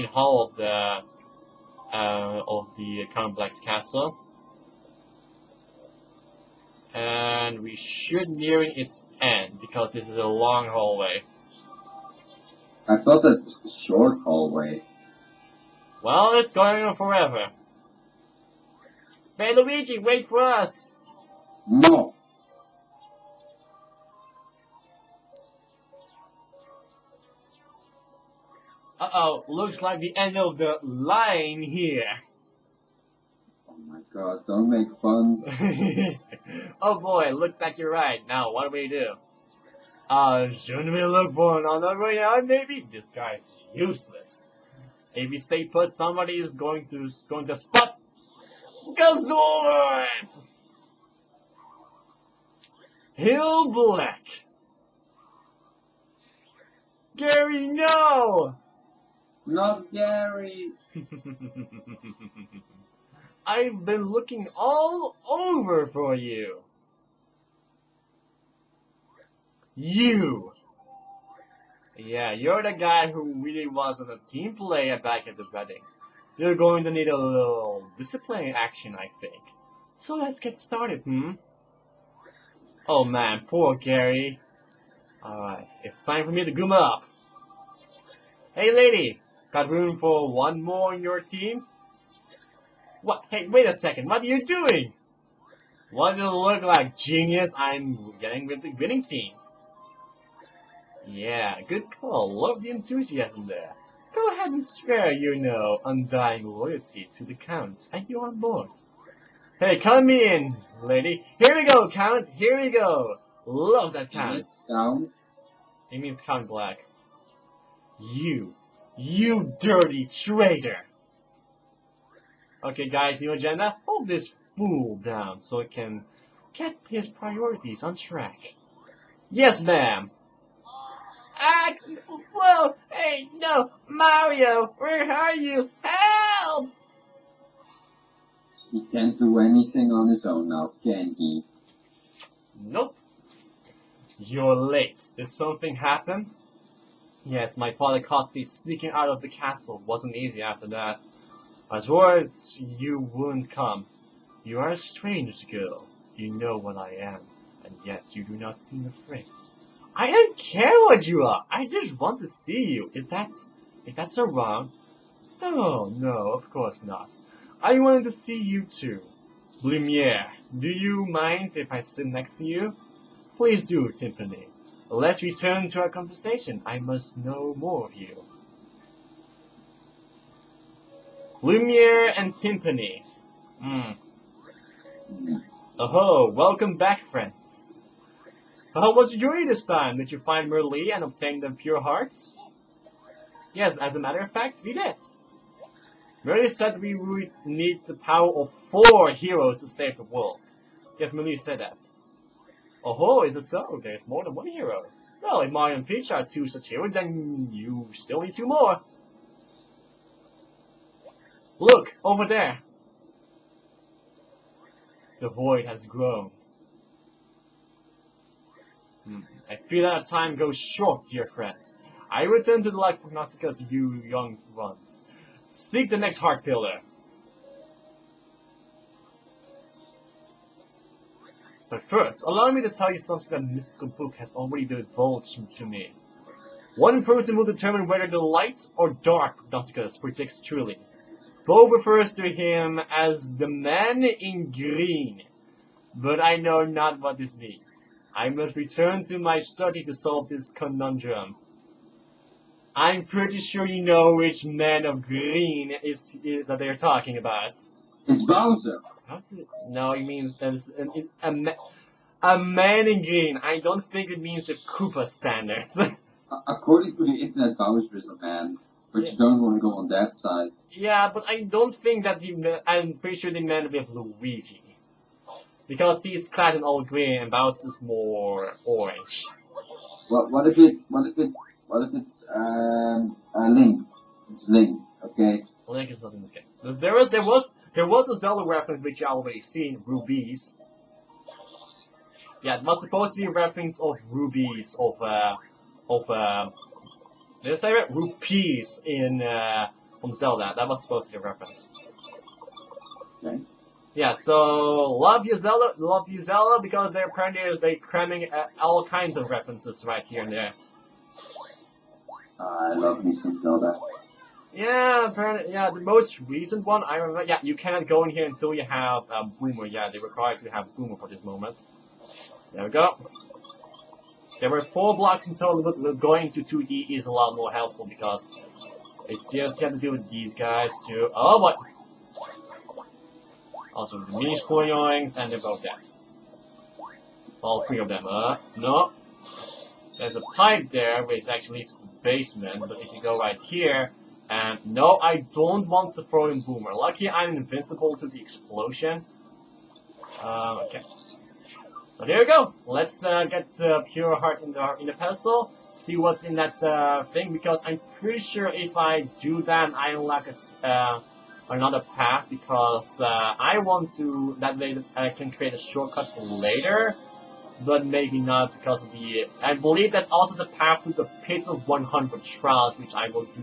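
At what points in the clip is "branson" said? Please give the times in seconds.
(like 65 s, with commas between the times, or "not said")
not said.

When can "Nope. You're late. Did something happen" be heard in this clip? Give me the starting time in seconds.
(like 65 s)
142 s.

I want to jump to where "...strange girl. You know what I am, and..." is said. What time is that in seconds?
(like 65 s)
154 s.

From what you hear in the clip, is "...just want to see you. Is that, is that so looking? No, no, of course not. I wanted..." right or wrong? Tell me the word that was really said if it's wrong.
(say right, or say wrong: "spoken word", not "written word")
wrong: "wrong", not "looking".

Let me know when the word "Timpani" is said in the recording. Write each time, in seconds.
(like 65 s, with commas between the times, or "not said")
173 s, 182 s.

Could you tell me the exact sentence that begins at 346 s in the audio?
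Lucky I'm invincible to the explosion.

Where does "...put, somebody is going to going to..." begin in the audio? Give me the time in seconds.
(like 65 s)
45 s.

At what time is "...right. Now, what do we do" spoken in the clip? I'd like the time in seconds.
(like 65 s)
37 s.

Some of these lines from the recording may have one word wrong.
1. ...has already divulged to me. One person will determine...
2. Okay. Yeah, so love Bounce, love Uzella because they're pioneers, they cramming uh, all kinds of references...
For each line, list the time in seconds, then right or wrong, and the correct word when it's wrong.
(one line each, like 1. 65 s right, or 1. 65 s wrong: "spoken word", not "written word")
1. 234 s right
2. 303 s wrong: "Uzella", not "Bounce".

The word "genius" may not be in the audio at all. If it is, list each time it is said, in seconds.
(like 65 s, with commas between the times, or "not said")
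96 s.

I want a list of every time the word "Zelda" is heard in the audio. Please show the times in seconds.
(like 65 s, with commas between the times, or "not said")
288 s, 300 s, 313 s.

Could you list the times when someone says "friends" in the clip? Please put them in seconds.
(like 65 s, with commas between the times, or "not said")
187 s, 221 s.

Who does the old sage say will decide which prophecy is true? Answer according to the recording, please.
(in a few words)
the man in green.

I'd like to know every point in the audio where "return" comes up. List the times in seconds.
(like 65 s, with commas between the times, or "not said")
175 s, 222 s, 248 s.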